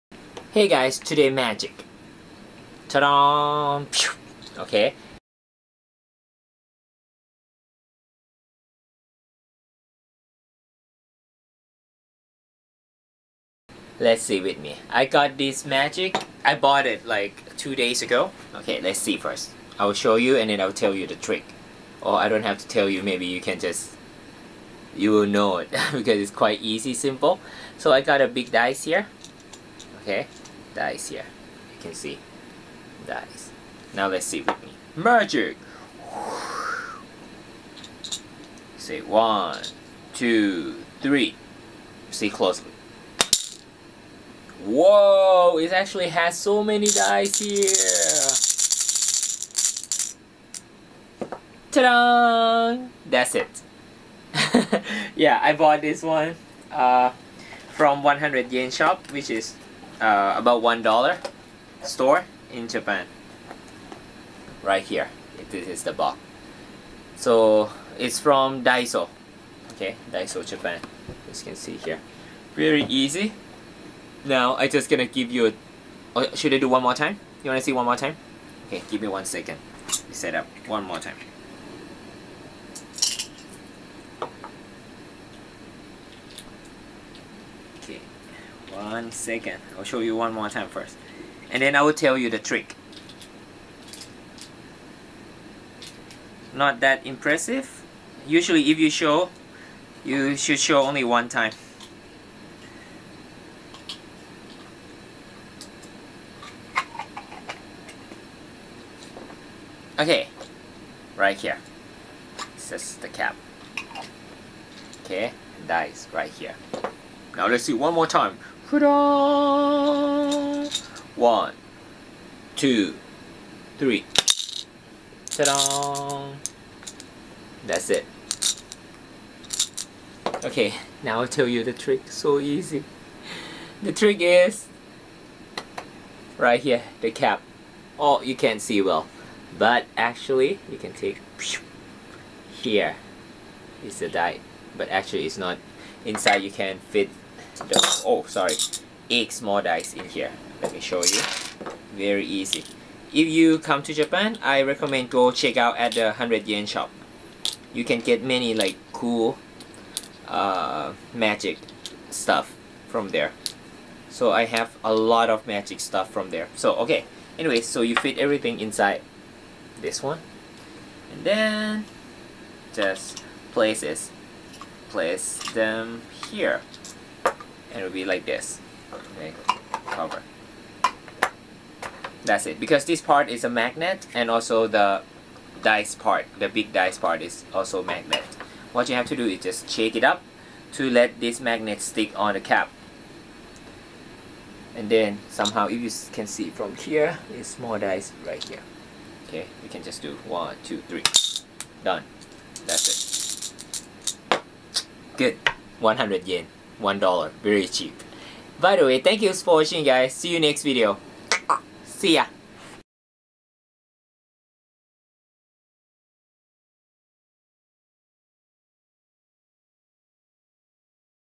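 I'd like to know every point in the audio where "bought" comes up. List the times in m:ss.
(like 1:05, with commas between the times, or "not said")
0:16, 0:55.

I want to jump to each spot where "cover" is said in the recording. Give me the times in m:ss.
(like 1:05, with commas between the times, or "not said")
2:59.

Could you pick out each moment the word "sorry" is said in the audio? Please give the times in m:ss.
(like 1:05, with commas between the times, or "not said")
2:28.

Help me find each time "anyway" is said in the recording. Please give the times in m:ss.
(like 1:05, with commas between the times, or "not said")
2:47.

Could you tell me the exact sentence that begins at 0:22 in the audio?
Or I don't have to tell you, maybe you can just...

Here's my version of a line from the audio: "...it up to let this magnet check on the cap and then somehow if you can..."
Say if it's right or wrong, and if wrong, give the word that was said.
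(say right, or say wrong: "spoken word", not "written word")
wrong: "stick", not "check".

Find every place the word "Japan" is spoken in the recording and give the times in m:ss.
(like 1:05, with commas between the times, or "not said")
1:02, 1:10, 2:33.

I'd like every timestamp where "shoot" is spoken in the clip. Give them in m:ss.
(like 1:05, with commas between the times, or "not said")
not said.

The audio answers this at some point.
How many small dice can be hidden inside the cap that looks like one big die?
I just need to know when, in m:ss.
2:29.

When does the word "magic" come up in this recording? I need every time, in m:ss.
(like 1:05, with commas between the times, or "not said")
0:01, 0:15, 0:34, 2:41, 2:45.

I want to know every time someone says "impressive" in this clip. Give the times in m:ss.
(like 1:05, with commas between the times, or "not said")
1:37.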